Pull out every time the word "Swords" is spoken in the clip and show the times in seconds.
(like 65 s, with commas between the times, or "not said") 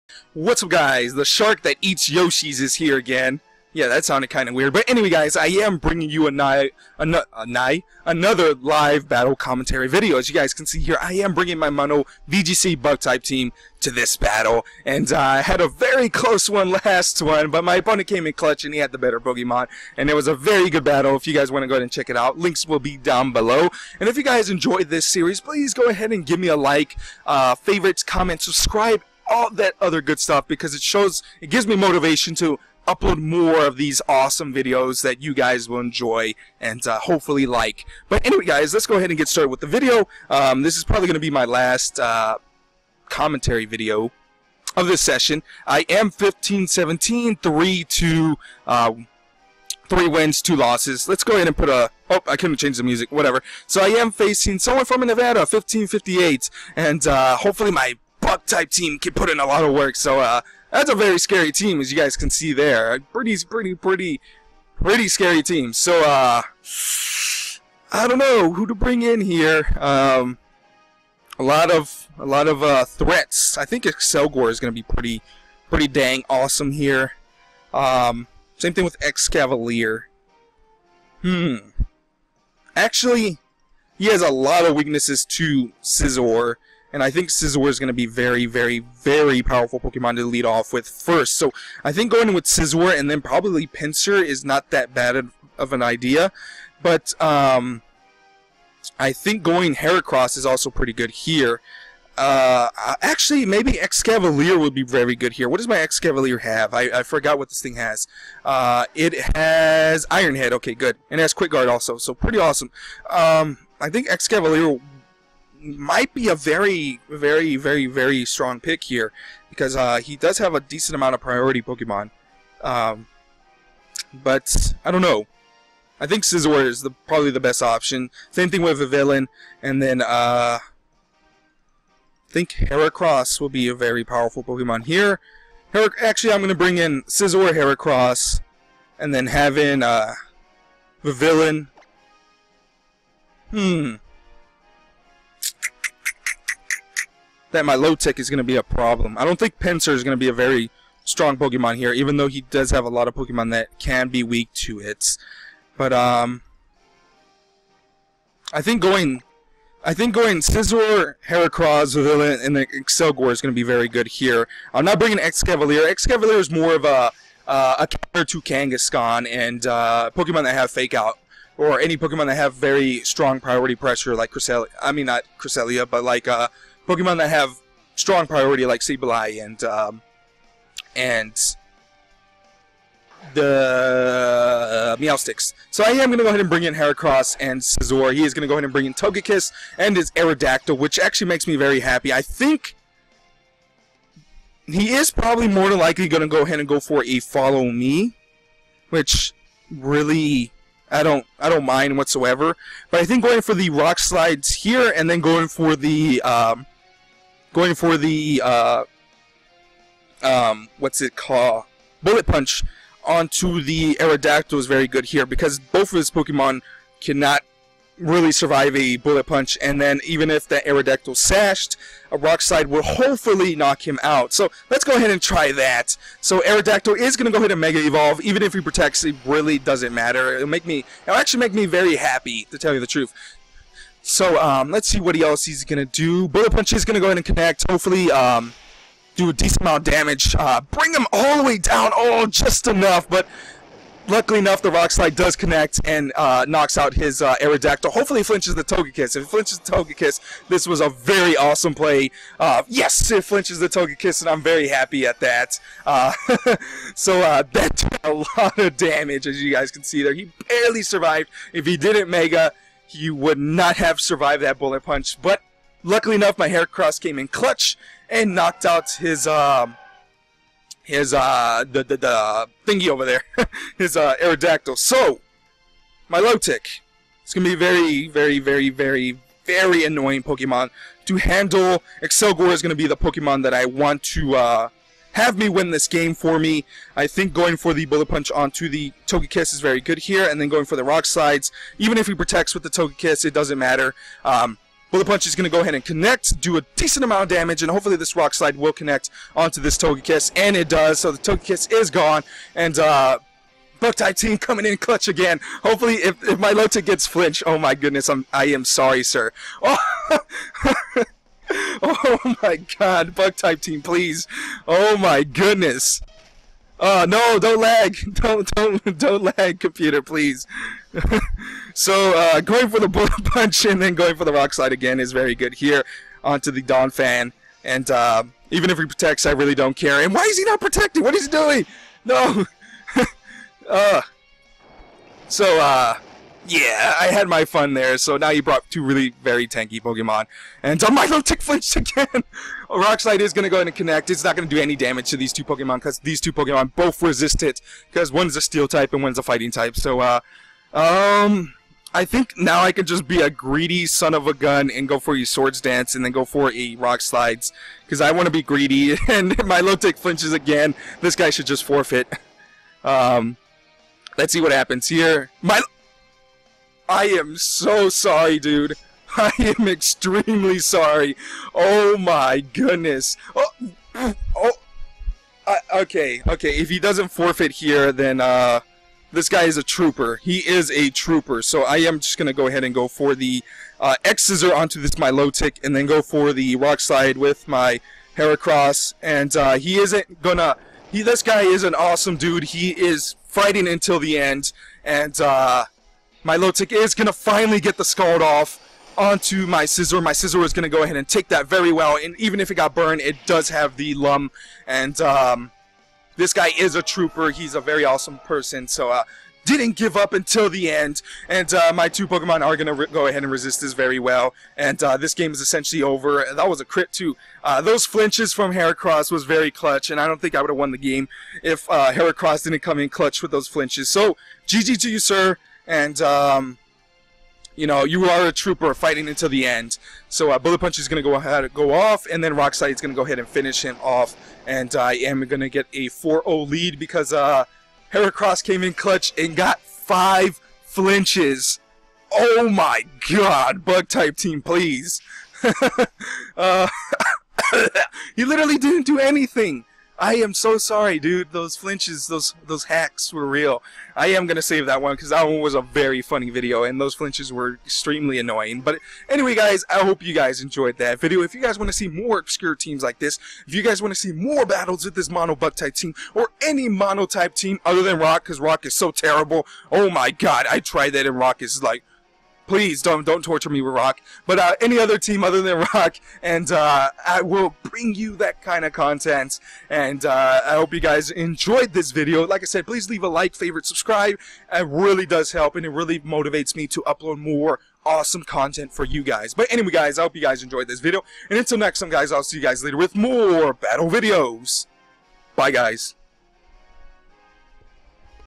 355 s.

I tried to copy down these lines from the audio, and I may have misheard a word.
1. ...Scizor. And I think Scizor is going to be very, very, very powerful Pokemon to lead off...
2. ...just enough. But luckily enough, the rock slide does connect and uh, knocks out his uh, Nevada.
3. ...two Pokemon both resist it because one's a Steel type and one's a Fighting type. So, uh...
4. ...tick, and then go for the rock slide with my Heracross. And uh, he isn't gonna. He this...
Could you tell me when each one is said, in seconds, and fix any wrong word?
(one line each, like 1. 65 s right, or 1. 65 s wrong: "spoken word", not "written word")
1. 85 s right
2. 242 s wrong: "Aerodactyl", not "Nevada"
3. 346 s right
4. 385 s right.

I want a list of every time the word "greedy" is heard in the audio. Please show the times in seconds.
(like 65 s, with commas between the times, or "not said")
353 s, 358 s.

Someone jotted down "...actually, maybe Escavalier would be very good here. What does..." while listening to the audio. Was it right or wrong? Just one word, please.
right.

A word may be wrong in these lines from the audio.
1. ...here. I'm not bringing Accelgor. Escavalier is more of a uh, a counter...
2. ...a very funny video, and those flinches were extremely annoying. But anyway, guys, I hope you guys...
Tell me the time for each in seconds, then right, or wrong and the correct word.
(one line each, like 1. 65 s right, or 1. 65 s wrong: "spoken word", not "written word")
1. 164 s wrong: "Escavalier", not "Accelgor"
2. 455 s right.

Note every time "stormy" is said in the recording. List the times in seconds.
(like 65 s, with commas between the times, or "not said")
not said.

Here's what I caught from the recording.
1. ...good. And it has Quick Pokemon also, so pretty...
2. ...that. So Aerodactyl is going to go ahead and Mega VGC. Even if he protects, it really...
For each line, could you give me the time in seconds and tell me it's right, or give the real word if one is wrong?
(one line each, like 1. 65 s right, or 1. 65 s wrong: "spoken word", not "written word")
1. 110 s wrong: "Guard", not "Pokemon"
2. 225 s wrong: "Evolve", not "VGC".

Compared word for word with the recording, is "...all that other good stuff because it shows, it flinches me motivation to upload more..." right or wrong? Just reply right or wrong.
wrong.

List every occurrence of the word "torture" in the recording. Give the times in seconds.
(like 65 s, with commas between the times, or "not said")
473 s.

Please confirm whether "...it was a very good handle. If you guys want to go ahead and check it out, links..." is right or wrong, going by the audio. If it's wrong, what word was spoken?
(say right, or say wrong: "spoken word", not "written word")
wrong: "battle", not "handle".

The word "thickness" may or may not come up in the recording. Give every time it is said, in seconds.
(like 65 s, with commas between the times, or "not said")
not said.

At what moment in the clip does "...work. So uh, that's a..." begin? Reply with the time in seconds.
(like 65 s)
59 s.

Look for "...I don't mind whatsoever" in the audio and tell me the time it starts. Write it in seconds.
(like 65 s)
201 s.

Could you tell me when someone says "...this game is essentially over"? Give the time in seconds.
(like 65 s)
414 s.